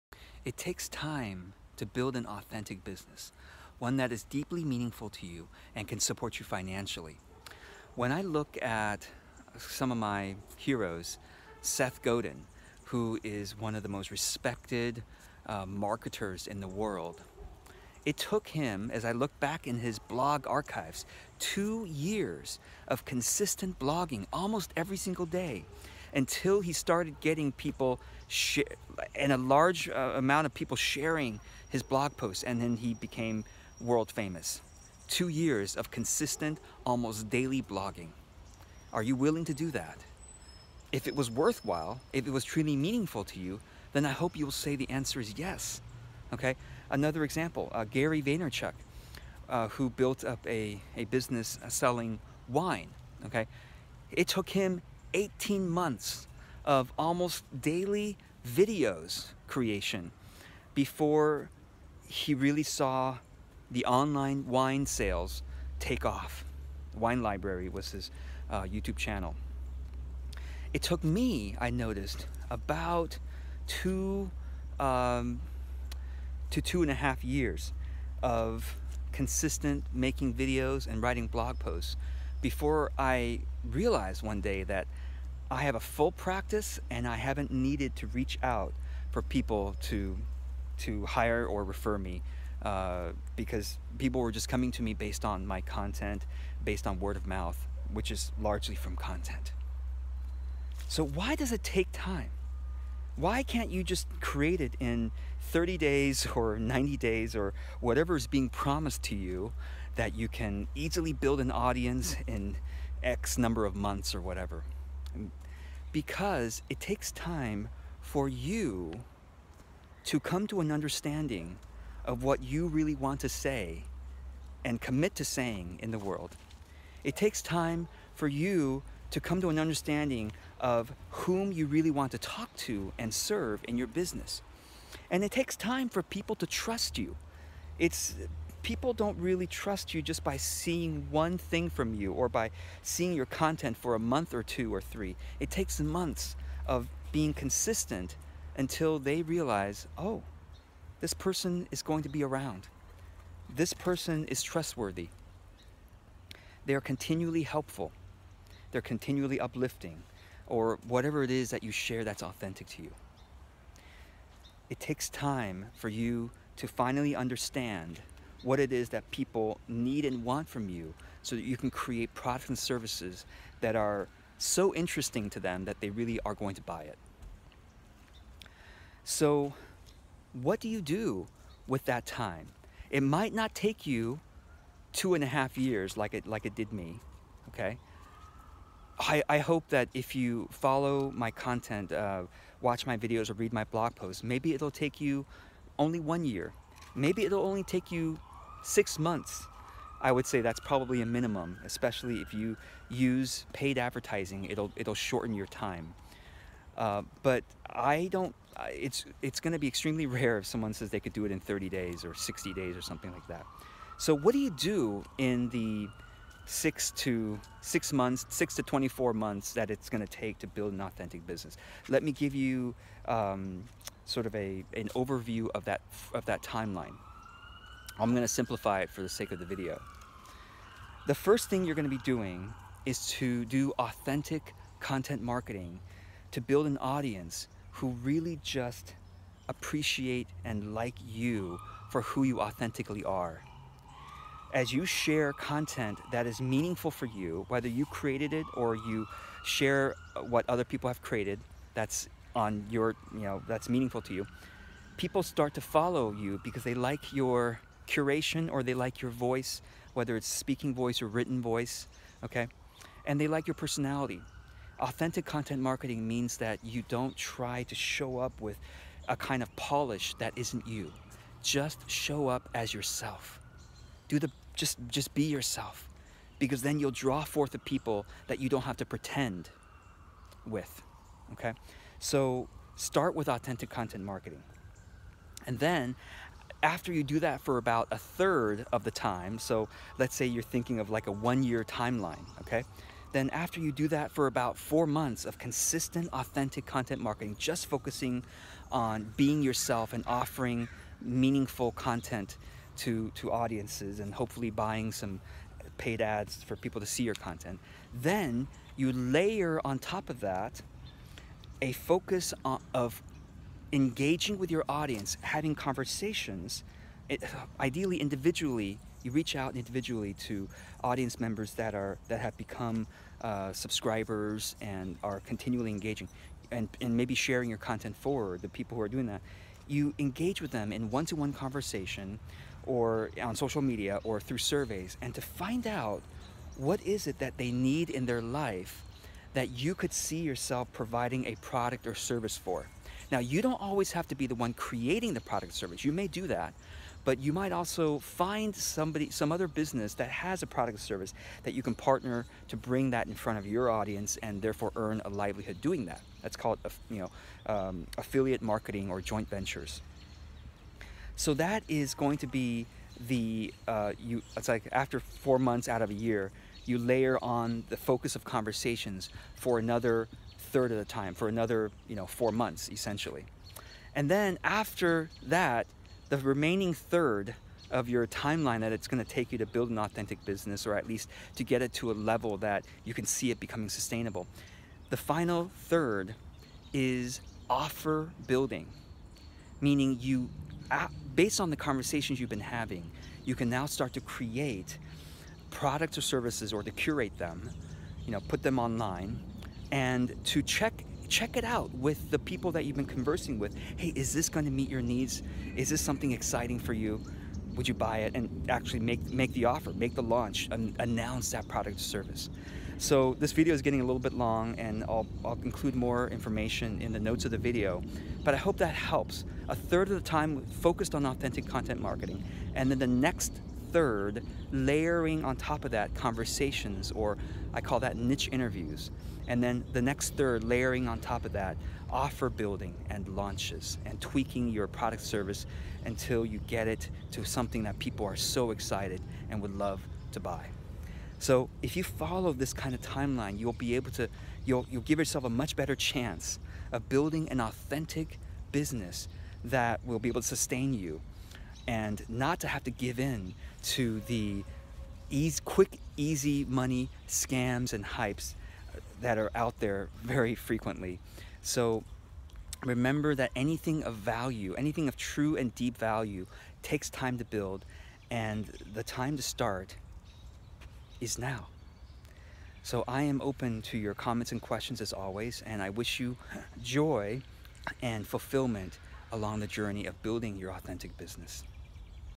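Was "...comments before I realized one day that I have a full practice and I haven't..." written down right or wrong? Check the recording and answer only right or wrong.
wrong.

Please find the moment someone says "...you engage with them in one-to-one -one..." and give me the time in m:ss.
5:29.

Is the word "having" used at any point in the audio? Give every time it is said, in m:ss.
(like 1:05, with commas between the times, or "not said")
5:15, 6:32.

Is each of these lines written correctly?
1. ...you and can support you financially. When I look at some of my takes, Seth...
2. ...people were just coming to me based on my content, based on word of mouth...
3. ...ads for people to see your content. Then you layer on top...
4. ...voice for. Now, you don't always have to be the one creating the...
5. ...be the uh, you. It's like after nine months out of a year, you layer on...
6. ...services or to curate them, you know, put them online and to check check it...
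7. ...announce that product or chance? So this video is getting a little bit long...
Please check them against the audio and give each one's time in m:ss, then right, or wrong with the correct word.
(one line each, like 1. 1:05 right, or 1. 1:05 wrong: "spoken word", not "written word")
1. 0:05 wrong: "heroes", not "takes"
2. 1:33 right
3. 5:06 right
4. 5:41 wrong: "service", not "voice"
5. 6:02 wrong: "four", not "nine"
6. 6:36 right
7. 6:50 wrong: "service", not "chance".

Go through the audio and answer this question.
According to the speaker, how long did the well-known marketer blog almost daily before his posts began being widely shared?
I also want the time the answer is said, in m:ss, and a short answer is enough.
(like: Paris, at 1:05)
2 years, at 0:21.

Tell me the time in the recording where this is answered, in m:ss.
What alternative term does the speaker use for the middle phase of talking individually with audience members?
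7:07.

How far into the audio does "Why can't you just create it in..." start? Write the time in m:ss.
1:43.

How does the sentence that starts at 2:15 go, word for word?
And it takes time for people to trust you.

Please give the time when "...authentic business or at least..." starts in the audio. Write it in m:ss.
6:19.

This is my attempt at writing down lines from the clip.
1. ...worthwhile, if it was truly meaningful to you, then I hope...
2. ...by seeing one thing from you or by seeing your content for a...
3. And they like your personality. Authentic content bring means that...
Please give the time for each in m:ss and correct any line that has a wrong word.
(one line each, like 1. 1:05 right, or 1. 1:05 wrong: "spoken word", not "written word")
1. 0:41 right
2. 2:20 right
3. 4:23 wrong: "marketing", not "bring".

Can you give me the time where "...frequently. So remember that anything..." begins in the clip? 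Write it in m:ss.
7:40.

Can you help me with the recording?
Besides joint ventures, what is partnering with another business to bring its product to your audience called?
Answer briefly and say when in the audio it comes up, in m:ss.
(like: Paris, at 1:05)
affiliate marketing, at 5:57.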